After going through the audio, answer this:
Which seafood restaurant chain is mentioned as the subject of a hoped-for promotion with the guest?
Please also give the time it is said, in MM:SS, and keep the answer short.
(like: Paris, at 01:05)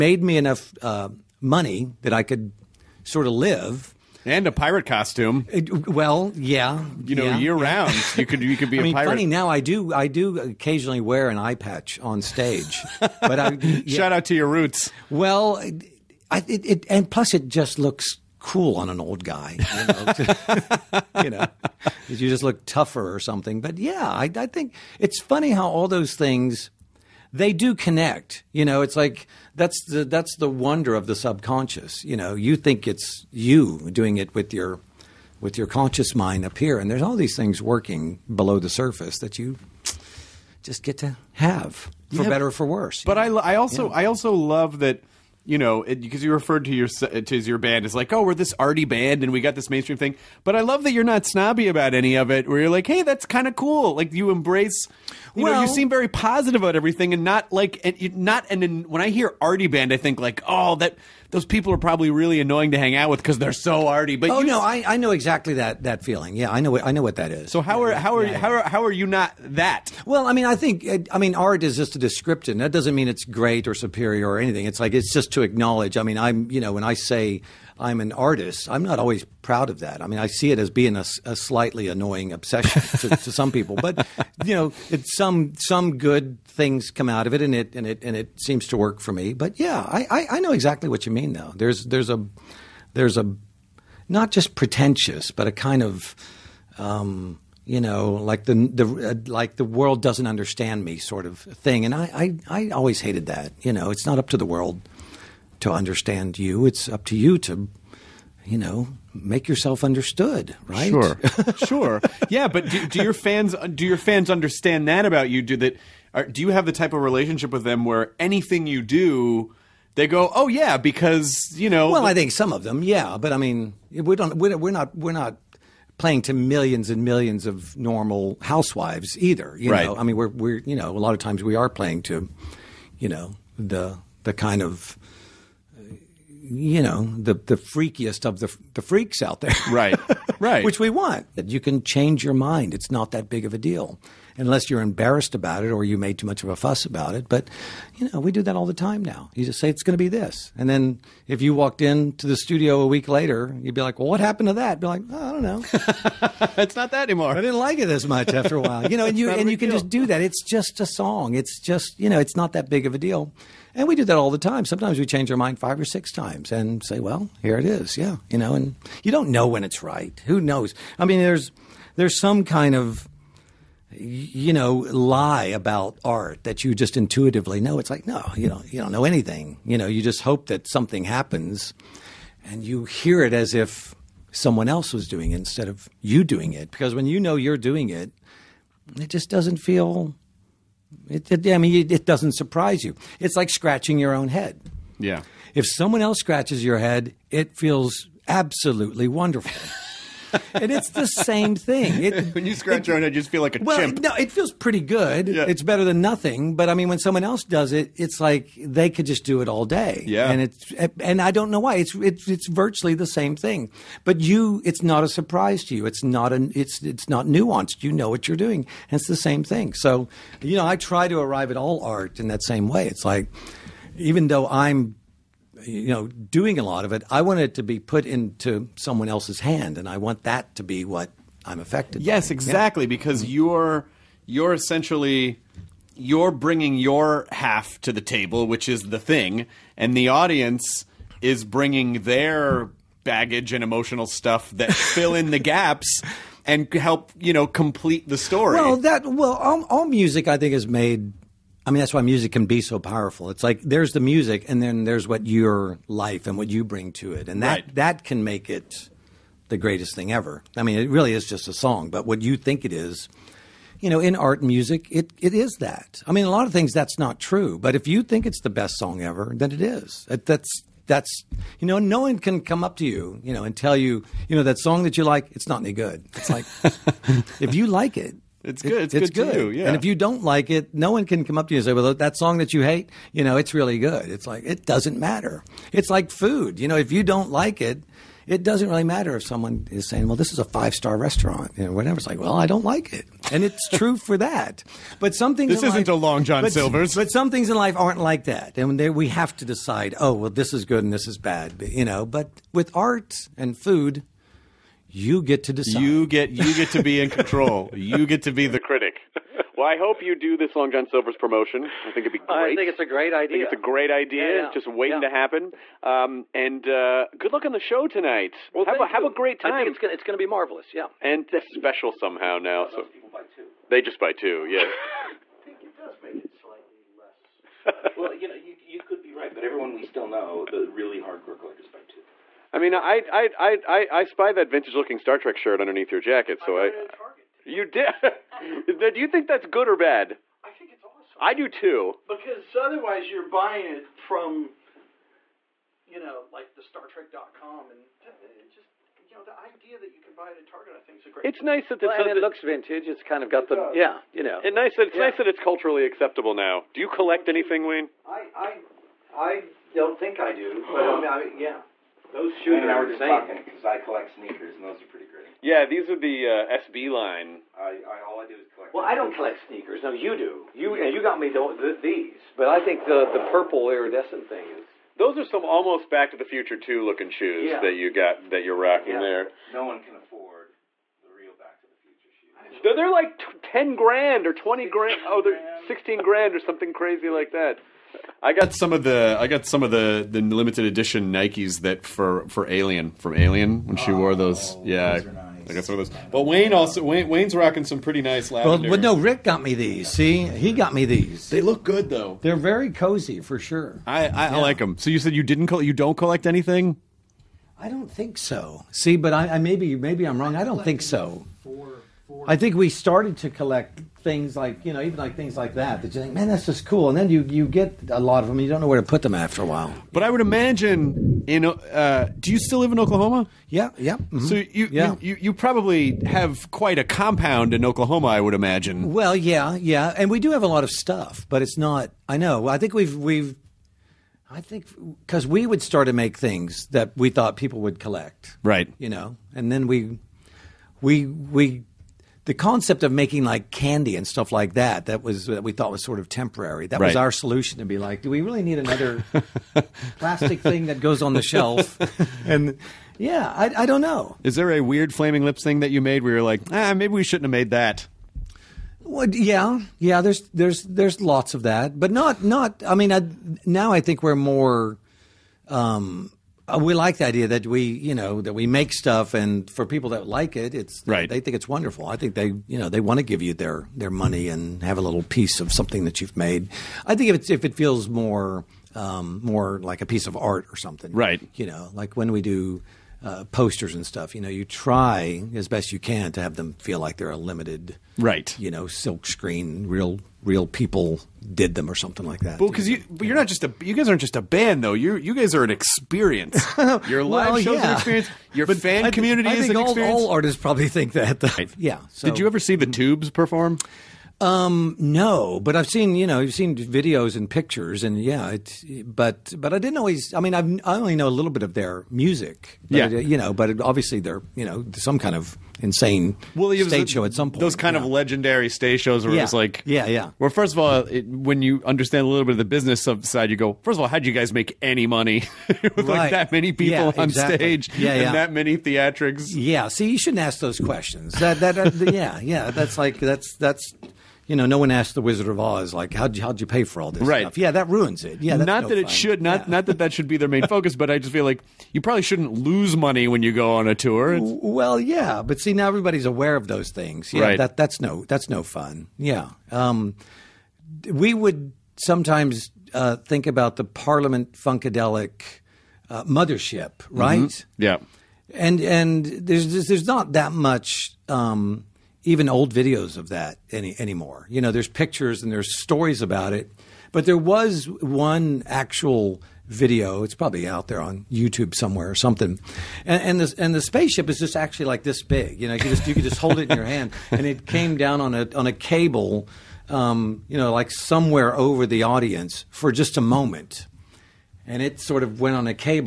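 Long John Silver's, at 05:10.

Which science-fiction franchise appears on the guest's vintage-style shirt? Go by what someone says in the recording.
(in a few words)
Star Trek.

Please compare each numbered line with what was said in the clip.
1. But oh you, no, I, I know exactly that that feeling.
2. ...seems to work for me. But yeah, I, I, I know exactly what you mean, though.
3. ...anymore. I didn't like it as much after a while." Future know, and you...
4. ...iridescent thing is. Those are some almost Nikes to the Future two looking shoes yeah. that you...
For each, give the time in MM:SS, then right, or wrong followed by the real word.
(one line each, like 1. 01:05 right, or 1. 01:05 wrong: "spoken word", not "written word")
1. 01:04 right
2. 01:28 right
3. 02:37 wrong: "You", not "Future"
4. 06:13 wrong: "Back", not "Nikes".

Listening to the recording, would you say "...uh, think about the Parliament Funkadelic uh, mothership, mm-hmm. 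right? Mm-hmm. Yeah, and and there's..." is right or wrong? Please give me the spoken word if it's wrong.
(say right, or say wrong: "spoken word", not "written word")
right.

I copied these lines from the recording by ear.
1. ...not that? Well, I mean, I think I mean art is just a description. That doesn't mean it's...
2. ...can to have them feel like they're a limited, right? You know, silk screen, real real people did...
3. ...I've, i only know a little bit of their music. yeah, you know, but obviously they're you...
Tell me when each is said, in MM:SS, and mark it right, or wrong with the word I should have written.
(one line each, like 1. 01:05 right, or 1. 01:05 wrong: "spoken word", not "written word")
1. 01:09 right
2. 08:05 right
3. 08:30 right.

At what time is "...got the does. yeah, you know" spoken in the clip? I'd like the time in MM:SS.
05:53.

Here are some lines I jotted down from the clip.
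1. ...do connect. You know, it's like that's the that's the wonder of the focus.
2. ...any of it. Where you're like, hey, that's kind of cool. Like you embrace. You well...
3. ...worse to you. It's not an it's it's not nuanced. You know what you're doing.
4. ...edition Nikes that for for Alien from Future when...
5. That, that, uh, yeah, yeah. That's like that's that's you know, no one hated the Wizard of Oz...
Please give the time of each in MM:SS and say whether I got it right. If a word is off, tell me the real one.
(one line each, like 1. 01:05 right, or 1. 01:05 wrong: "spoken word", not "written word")
1. 00:27 wrong: "subconscious", not "focus"
2. 00:51 right
3. 03:35 wrong: "surprise", not "worse"
4. 06:30 wrong: "Alien", not "Future"
5. 08:51 wrong: "asked", not "hated".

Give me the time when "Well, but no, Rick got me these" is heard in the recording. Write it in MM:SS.
06:38.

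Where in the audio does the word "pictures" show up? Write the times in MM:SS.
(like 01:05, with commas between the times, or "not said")
08:27, 09:24.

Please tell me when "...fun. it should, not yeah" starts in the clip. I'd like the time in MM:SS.
08:58.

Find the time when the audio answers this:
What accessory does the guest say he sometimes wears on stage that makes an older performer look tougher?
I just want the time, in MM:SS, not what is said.
00:11.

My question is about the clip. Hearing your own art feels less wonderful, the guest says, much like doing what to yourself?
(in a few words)
scratching your own head.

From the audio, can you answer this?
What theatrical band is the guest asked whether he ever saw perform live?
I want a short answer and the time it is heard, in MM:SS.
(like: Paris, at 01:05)
the Tubes, at 08:22.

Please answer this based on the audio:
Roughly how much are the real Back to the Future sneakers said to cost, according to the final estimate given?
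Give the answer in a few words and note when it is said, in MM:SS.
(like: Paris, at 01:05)
16 grand, at 06:25.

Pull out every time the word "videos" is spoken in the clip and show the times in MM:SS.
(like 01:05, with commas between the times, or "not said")
08:26, 09:22, 09:29.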